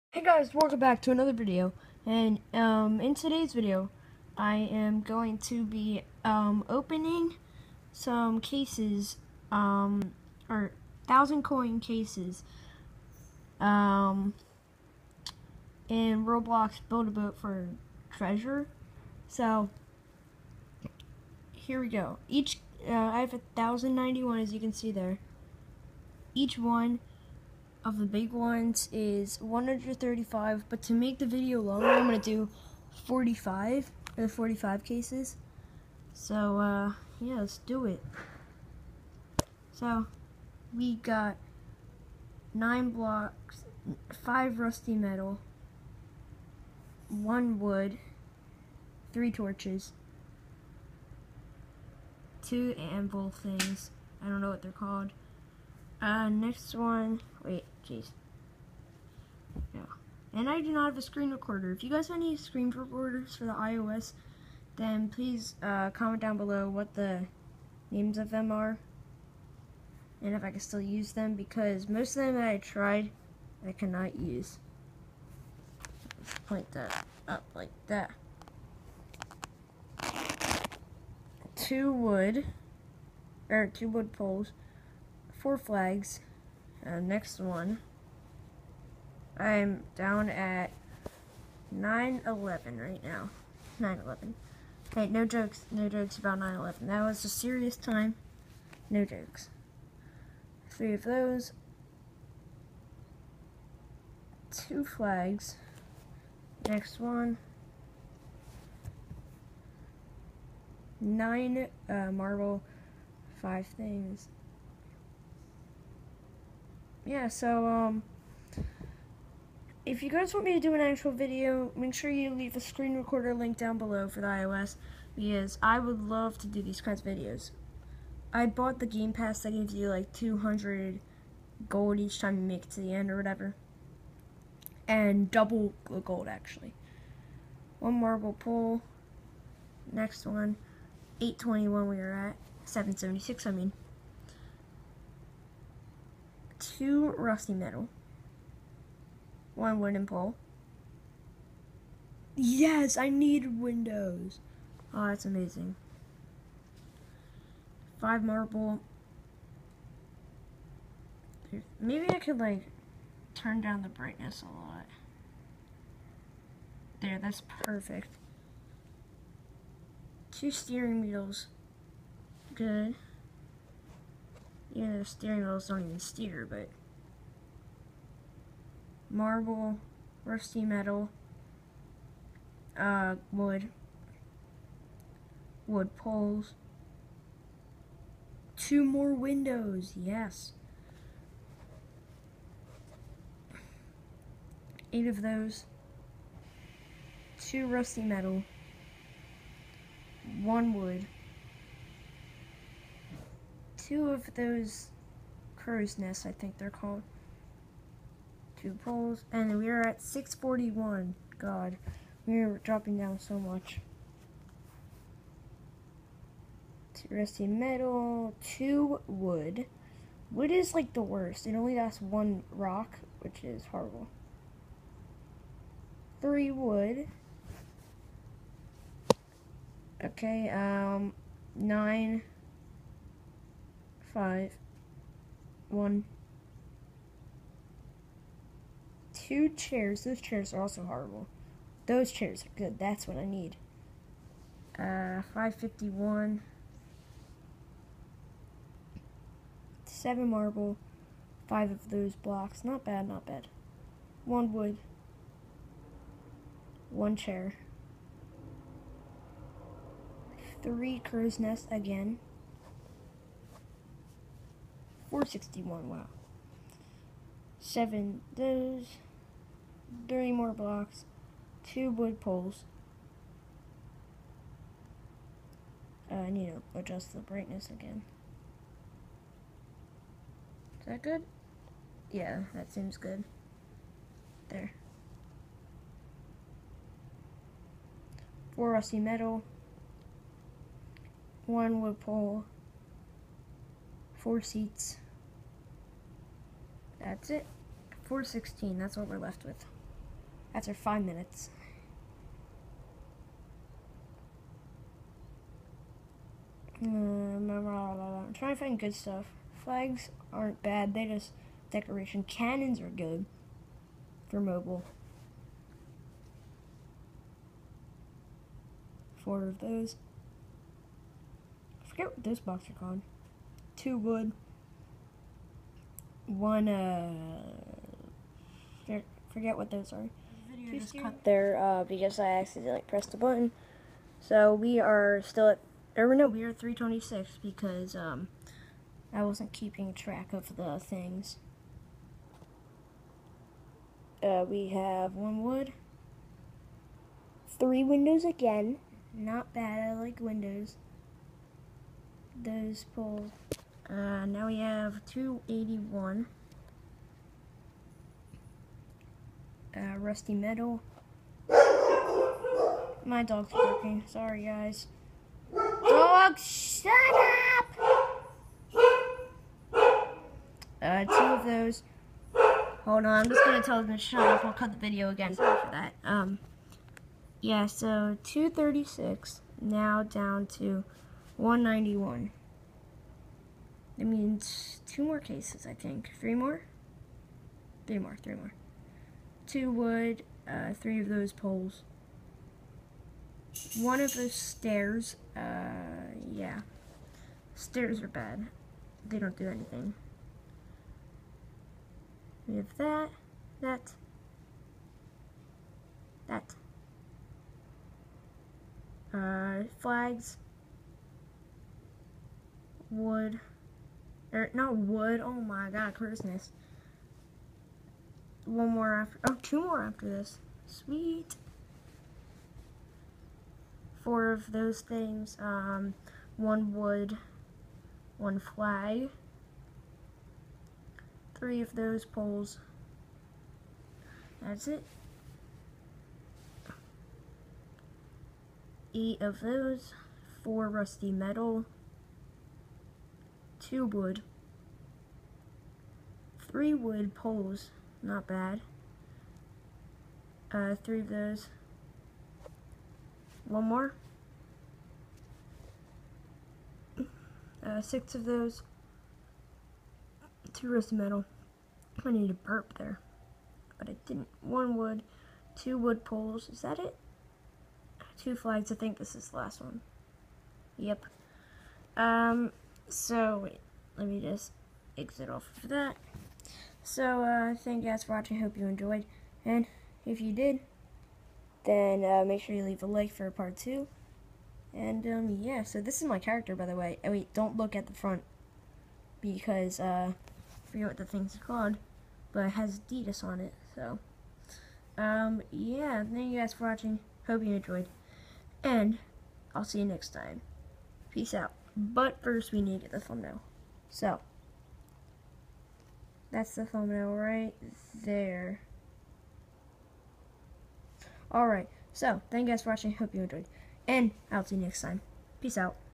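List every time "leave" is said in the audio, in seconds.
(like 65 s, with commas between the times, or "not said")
122 s, 482 s.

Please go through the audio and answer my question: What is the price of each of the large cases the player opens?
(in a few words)
135.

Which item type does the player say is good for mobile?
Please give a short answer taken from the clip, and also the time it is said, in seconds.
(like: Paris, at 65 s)
Cannons, at 312 s.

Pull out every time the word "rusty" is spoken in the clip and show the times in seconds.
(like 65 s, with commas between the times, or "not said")
44 s, 147 s, 180 s, 197 s, 217 s, 288 s, 359 s, 440 s.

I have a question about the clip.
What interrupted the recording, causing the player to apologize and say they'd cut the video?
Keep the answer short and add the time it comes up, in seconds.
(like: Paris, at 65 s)
dog barking, at 363 s.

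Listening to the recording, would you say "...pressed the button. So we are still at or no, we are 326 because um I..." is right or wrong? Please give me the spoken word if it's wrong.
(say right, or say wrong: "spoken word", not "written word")
right.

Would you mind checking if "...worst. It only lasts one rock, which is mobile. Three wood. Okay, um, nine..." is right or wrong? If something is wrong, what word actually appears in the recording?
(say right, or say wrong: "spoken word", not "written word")
wrong: "horrible", not "mobile".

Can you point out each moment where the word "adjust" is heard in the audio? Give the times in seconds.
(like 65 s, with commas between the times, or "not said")
276 s.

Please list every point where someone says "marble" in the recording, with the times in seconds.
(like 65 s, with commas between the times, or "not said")
112 s, 137 s, 158 s, 179 s, 250 s.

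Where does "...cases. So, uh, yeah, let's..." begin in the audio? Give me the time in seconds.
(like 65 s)
34 s.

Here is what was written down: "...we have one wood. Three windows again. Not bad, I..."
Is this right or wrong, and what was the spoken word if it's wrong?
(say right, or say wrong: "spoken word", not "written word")
right.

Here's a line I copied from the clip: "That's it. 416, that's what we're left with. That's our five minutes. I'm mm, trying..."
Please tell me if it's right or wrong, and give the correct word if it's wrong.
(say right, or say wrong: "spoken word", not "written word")
right.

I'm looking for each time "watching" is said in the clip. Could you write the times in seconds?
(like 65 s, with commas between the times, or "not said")
478 s, 496 s, 512 s.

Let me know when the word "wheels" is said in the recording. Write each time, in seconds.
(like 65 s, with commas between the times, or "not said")
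171 s, 175 s.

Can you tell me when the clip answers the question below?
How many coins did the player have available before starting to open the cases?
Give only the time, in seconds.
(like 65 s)
23 s.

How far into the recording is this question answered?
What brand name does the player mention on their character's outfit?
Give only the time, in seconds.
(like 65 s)
492 s.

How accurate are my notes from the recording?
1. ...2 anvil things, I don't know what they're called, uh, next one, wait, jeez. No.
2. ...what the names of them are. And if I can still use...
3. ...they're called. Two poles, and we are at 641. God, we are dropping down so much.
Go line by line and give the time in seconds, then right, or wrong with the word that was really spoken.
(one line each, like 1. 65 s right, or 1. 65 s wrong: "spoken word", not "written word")
1. 52 s right
2. 66 s right
3. 206 s right.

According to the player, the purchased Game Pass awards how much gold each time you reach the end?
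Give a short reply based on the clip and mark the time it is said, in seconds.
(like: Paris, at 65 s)
200, at 130 s.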